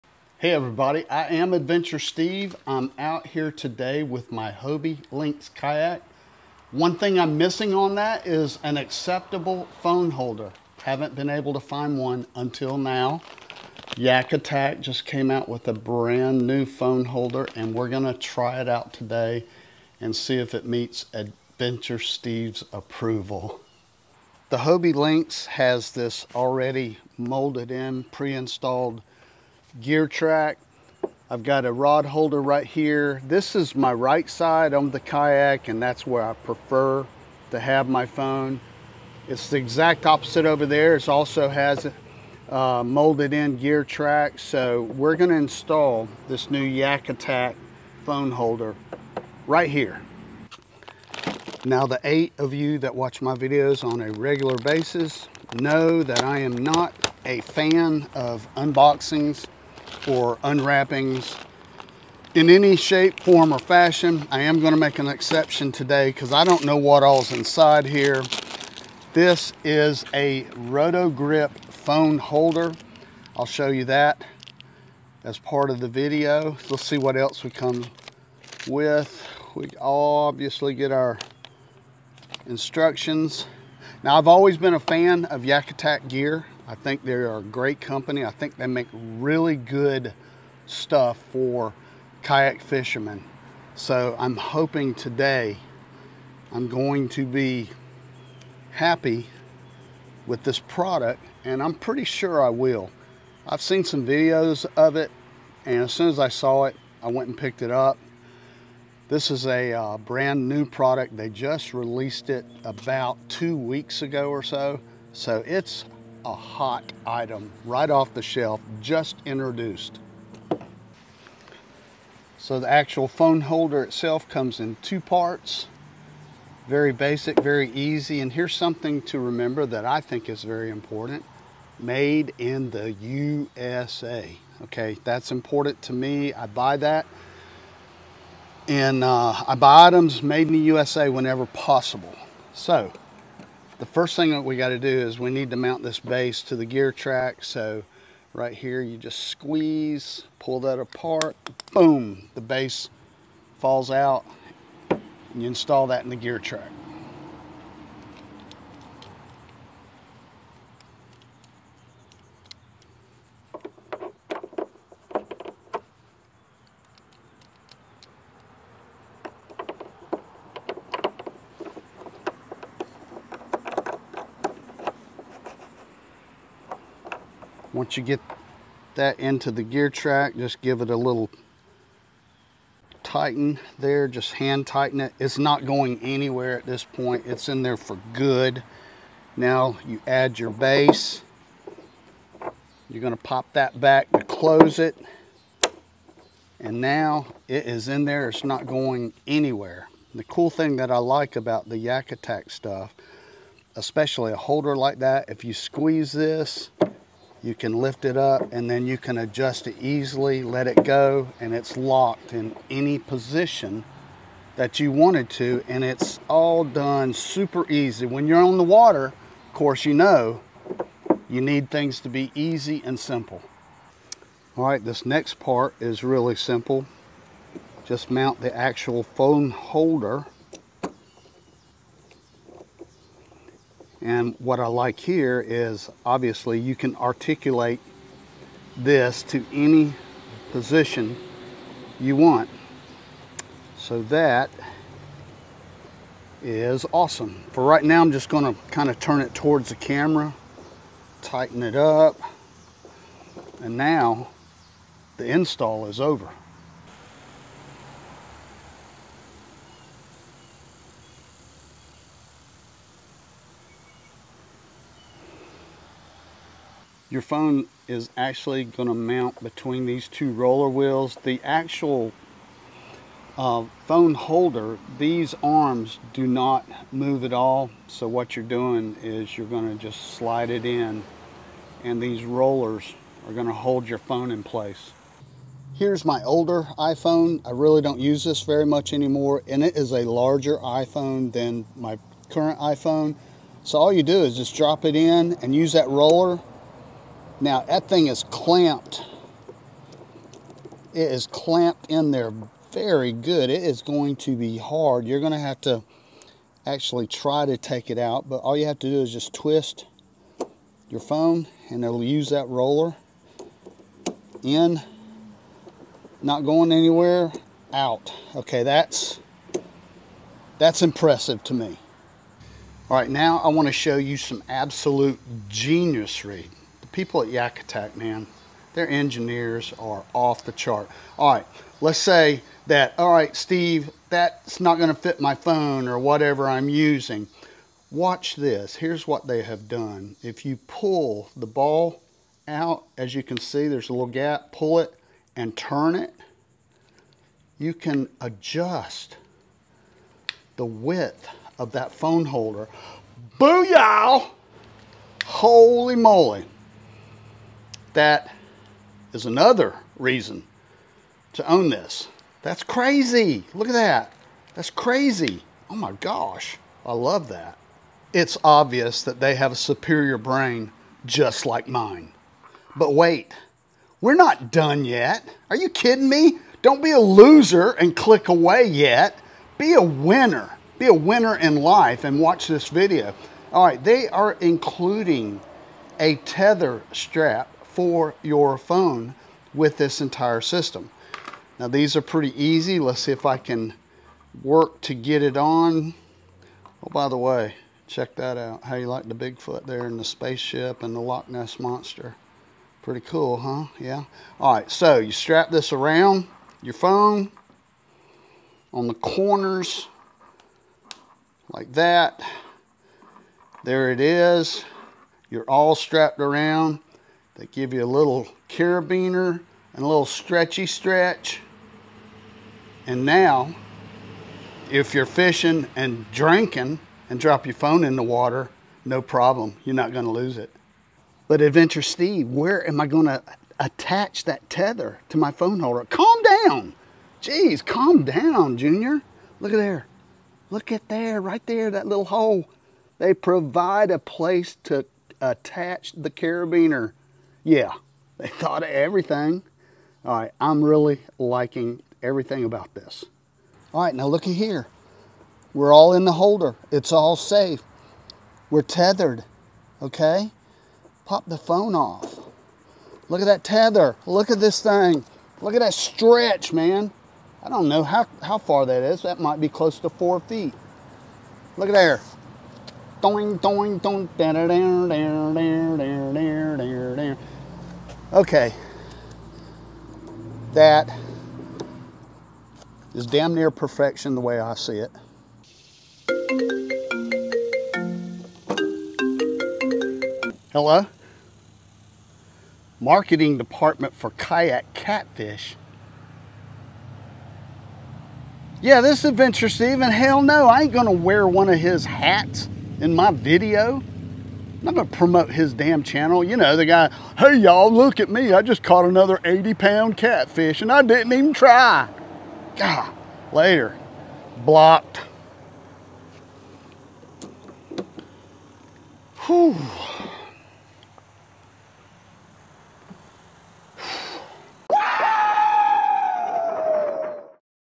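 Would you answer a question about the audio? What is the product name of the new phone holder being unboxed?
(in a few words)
Roto-Grip.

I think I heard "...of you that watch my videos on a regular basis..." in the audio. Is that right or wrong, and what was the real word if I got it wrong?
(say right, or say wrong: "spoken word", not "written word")
right.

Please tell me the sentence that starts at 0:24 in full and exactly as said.
The Hobie Lynx has this already molded in, pre-installed gear track.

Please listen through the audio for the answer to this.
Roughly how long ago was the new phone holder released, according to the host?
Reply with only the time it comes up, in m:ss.
1:53.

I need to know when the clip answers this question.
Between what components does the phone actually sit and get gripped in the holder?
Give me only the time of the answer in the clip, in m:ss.
4:30.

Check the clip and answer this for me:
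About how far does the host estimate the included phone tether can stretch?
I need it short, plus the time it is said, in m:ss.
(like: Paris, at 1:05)
4 feet, at 7:49.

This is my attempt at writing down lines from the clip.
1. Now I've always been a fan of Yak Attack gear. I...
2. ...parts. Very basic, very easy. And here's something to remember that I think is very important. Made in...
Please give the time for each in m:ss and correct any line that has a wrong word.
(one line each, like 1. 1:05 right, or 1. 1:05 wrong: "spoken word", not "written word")
1. 1:24 right
2. 2:04 right.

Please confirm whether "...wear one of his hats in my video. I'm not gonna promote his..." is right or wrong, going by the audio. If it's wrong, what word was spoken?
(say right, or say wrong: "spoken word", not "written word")
right.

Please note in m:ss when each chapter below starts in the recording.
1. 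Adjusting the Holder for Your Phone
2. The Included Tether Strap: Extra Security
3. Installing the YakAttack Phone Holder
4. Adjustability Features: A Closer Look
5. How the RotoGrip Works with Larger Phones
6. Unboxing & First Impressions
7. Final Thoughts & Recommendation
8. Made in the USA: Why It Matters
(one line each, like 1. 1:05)
1. 3:14
2. 6:21
3. 0:40
4. 5:34
5. 4:52
6. 1:25
7. 7:07
8. 2:10.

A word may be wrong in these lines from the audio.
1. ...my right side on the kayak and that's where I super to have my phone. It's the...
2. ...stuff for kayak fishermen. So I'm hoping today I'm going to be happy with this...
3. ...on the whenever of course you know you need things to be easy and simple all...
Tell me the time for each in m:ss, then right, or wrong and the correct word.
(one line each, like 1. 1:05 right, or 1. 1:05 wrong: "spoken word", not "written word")
1. 0:33 wrong: "prefer", not "super"
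2. 1:30 right
3. 3:38 wrong: "water", not "whenever".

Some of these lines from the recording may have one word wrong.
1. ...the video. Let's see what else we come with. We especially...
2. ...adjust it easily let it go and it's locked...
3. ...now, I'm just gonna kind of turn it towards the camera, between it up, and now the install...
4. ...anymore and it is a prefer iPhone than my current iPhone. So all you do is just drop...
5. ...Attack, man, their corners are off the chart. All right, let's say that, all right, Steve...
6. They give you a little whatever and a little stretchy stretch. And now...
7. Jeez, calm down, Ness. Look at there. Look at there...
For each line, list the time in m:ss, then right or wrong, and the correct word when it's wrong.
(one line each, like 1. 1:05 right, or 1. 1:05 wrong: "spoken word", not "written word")
1. 1:15 wrong: "obviously", not "especially"
2. 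3:29 right
3. 4:07 wrong: "tighten", not "between"
4. 4:48 wrong: "larger", not "prefer"
5. 5:27 wrong: "engineers", not "corners"
6. 6:57 wrong: "carabiner", not "whatever"
7. 7:17 wrong: "Junior", not "Ness".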